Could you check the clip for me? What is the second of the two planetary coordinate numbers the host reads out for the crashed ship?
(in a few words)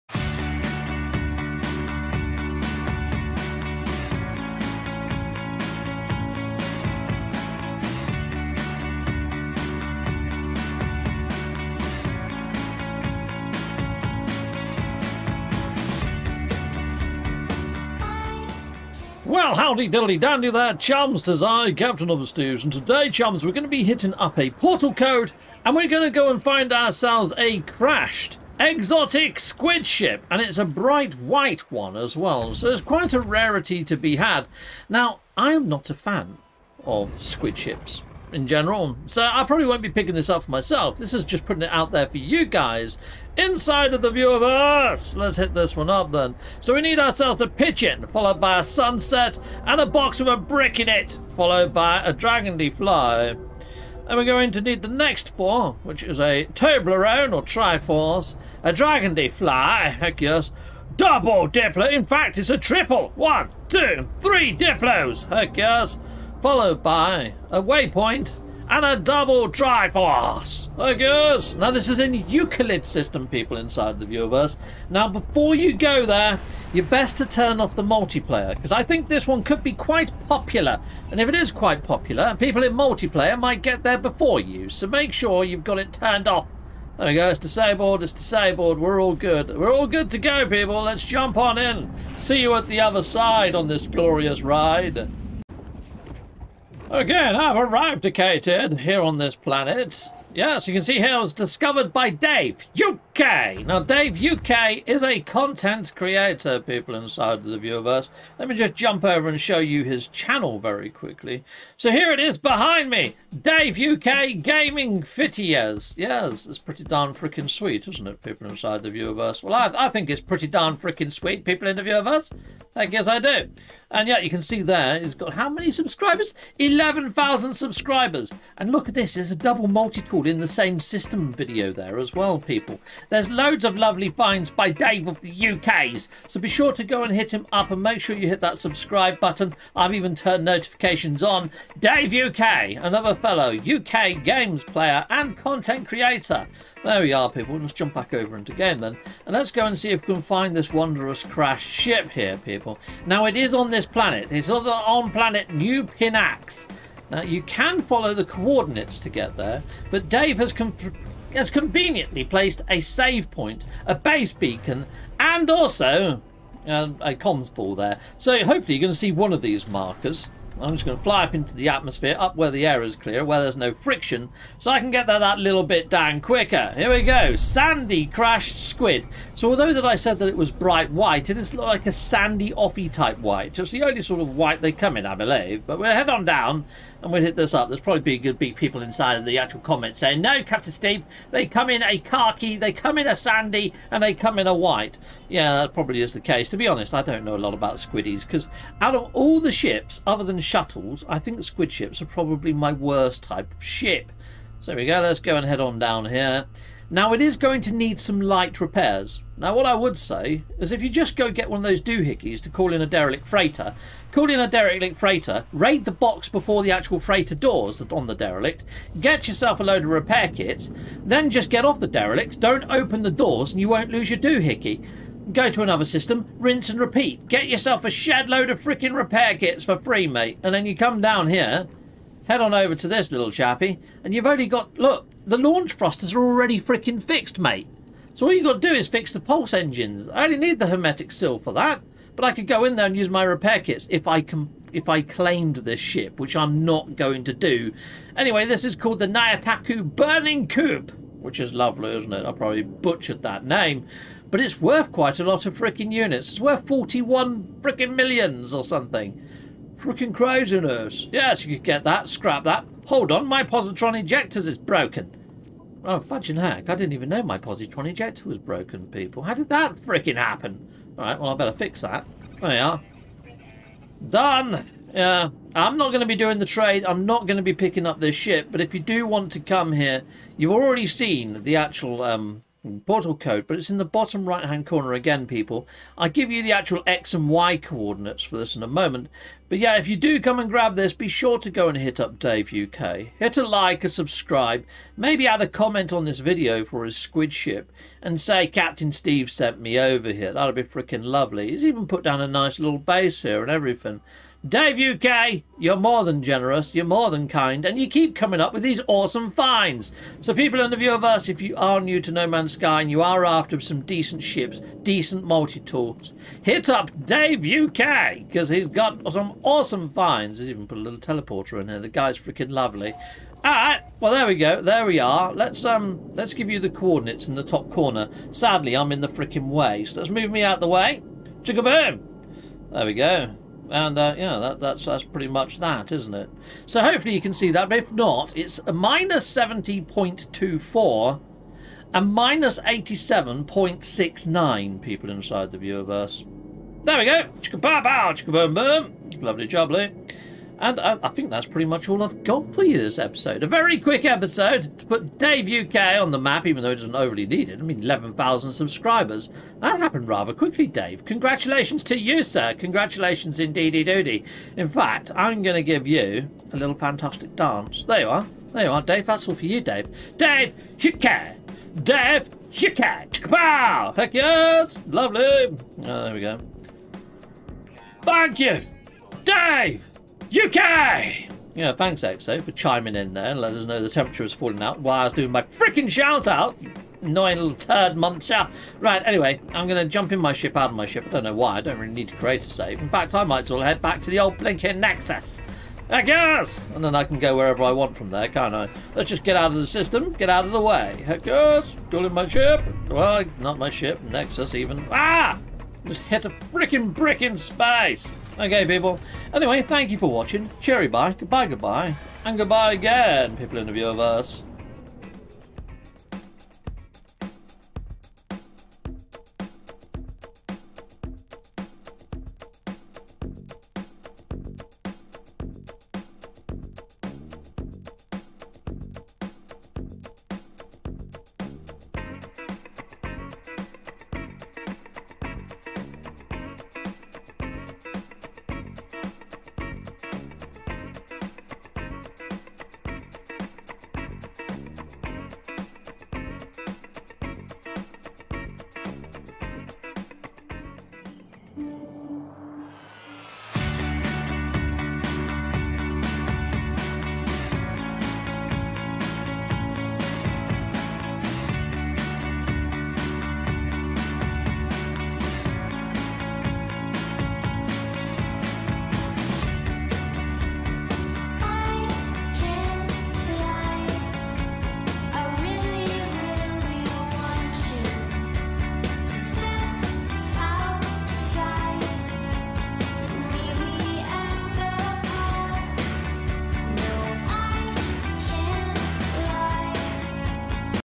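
-87.69.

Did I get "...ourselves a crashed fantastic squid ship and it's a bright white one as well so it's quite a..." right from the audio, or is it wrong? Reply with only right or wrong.
wrong.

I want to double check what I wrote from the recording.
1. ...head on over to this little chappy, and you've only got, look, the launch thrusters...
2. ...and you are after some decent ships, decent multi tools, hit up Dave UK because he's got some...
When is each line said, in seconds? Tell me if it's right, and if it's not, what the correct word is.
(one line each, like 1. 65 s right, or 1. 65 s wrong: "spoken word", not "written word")
1. 232 s right
2. 312 s right.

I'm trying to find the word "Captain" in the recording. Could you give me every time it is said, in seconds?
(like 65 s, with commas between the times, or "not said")
21 s, 190 s, 298 s.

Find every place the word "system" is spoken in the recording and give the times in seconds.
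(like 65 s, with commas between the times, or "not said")
72 s, 130 s, 225 s, 399 s.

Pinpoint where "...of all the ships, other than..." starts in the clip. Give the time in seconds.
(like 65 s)
198 s.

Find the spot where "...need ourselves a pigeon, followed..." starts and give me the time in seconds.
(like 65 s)
46 s.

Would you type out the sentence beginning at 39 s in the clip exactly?
So I probably won't be picking this up for myself.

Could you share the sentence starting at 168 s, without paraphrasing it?
So hopefully you're going to see one of these markers.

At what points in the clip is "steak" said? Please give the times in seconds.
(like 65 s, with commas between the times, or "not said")
not said.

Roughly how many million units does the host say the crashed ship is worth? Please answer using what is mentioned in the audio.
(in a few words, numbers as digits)
41 million.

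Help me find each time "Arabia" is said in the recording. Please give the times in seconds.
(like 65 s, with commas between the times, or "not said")
not said.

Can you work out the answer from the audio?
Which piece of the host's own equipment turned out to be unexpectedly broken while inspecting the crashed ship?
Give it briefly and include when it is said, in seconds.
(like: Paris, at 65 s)
Positron ejector, at 267 s.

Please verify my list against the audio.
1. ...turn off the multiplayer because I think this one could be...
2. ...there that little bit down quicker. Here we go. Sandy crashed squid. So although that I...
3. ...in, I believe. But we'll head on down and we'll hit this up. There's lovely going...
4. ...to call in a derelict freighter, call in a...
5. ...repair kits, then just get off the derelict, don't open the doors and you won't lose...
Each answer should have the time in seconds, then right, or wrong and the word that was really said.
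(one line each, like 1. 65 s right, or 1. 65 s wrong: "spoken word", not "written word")
1. 77 s right
2. 175 s right
3. 184 s wrong: "probably", not "lovely"
4. 212 s right
5. 219 s right.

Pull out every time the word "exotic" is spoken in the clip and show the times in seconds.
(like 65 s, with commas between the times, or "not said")
28 s.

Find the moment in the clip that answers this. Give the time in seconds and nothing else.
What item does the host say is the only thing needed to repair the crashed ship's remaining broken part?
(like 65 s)
240 s.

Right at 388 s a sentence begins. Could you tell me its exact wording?
Right, anyway, I'm going to jump in my ship out of my ship.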